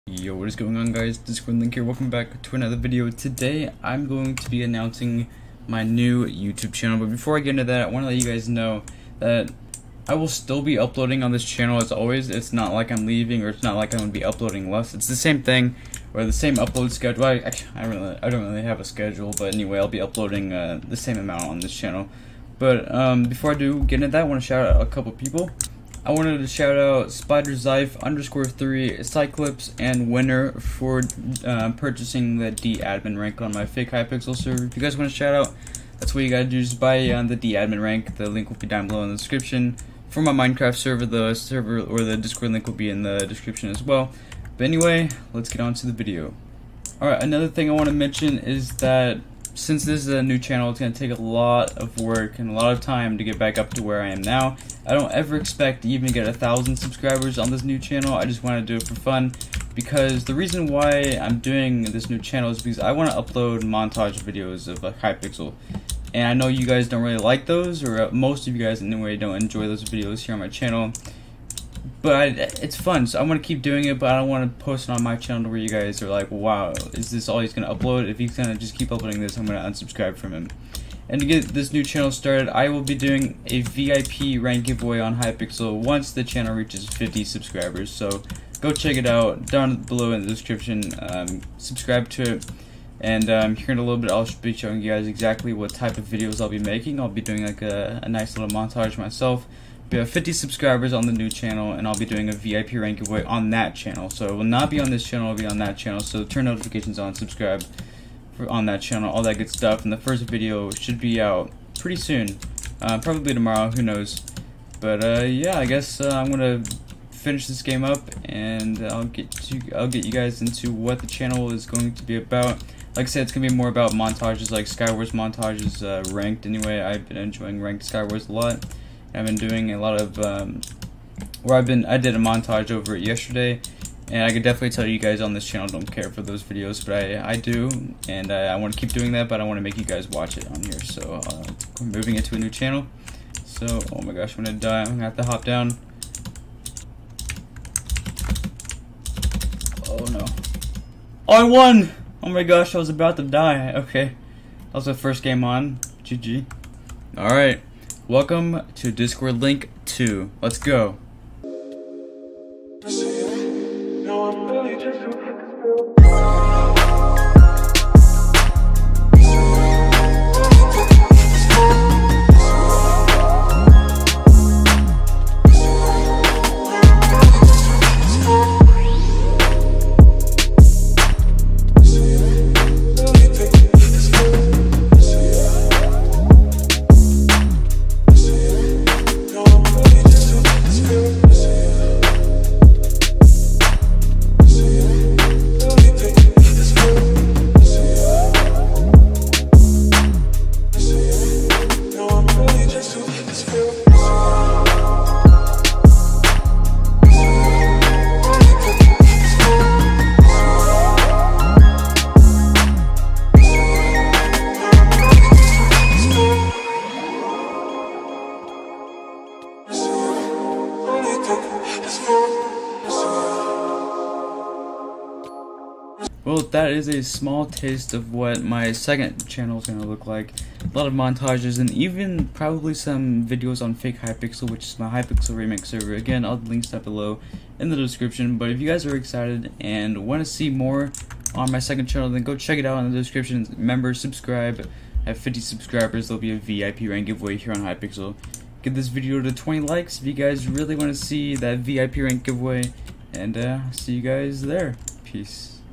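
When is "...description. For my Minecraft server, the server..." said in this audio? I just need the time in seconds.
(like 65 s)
39 s.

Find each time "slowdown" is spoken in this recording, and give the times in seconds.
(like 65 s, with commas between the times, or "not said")
not said.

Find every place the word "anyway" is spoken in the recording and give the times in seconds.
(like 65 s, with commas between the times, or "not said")
19 s, 44 s, 68 s, 126 s.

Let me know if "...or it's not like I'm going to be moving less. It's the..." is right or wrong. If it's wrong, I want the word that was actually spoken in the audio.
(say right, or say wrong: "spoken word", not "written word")
wrong: "uploading", not "moving".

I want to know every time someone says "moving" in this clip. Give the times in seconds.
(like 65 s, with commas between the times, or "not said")
141 s.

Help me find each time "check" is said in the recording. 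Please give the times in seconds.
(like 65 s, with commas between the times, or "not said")
88 s, 242 s.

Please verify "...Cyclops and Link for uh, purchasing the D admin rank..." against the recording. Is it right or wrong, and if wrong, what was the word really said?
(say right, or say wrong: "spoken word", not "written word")
wrong: "Winner", not "Link".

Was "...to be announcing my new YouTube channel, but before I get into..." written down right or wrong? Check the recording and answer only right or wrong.
right.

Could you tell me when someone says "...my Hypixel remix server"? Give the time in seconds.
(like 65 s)
234 s.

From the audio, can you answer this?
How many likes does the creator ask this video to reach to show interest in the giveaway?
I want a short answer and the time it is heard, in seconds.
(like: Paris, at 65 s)
20, at 249 s.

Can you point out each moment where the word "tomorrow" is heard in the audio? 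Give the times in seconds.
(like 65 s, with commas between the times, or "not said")
113 s.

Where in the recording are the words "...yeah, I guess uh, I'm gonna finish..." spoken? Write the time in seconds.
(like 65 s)
115 s.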